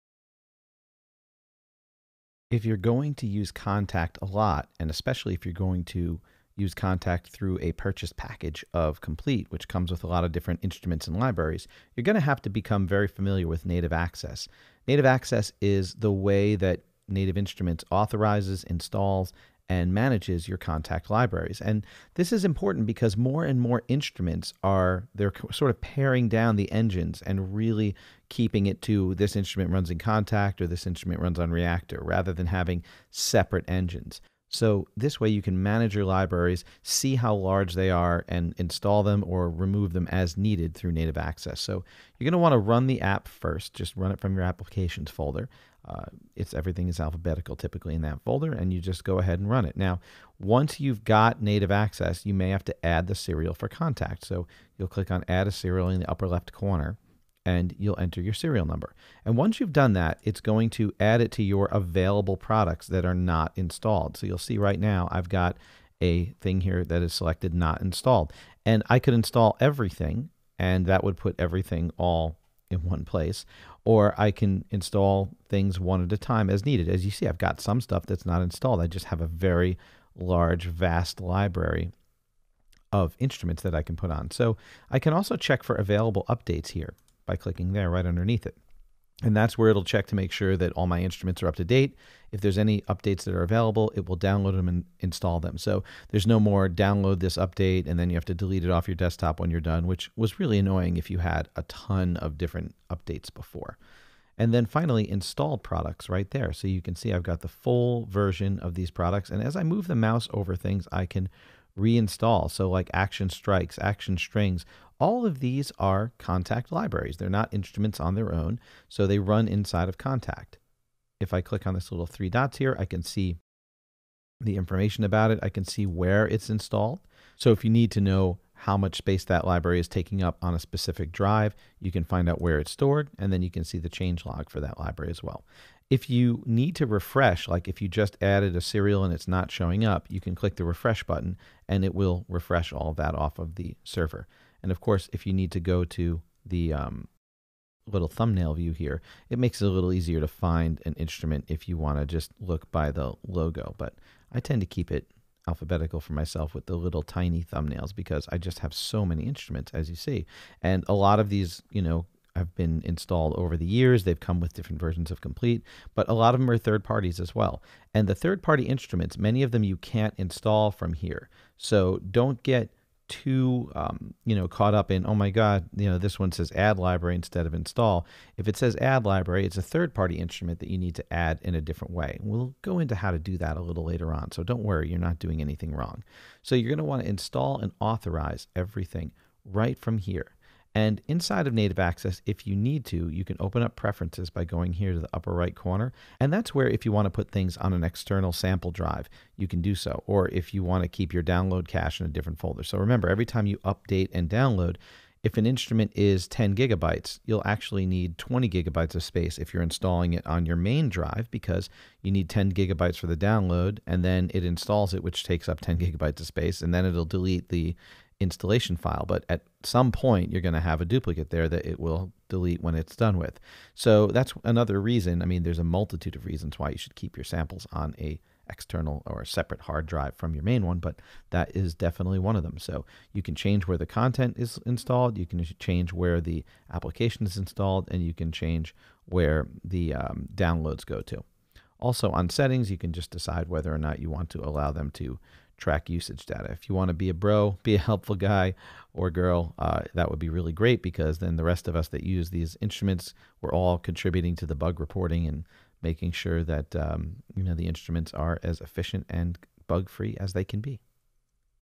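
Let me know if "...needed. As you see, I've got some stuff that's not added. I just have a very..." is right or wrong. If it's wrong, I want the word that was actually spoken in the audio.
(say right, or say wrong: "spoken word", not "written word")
wrong: "installed", not "added".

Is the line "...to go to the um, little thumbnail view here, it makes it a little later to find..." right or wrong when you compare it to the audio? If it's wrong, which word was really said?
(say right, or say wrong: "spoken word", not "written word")
wrong: "easier", not "later".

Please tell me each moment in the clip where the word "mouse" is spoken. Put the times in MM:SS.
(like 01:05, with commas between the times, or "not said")
01:49.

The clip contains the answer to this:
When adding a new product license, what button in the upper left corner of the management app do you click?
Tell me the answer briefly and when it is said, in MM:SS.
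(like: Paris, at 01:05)
add a serial, at 00:55.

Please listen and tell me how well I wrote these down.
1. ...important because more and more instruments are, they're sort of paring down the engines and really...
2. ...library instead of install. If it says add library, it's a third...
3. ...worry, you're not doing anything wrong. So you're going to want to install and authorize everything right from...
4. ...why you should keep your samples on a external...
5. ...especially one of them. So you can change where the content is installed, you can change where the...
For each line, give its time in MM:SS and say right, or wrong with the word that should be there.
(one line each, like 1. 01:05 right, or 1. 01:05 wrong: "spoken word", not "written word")
1. 00:22 right
2. 02:56 right
3. 03:04 right
4. 03:46 right
5. 03:51 wrong: "definitely", not "especially".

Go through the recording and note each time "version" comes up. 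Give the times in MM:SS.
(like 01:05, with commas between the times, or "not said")
01:48, 02:44.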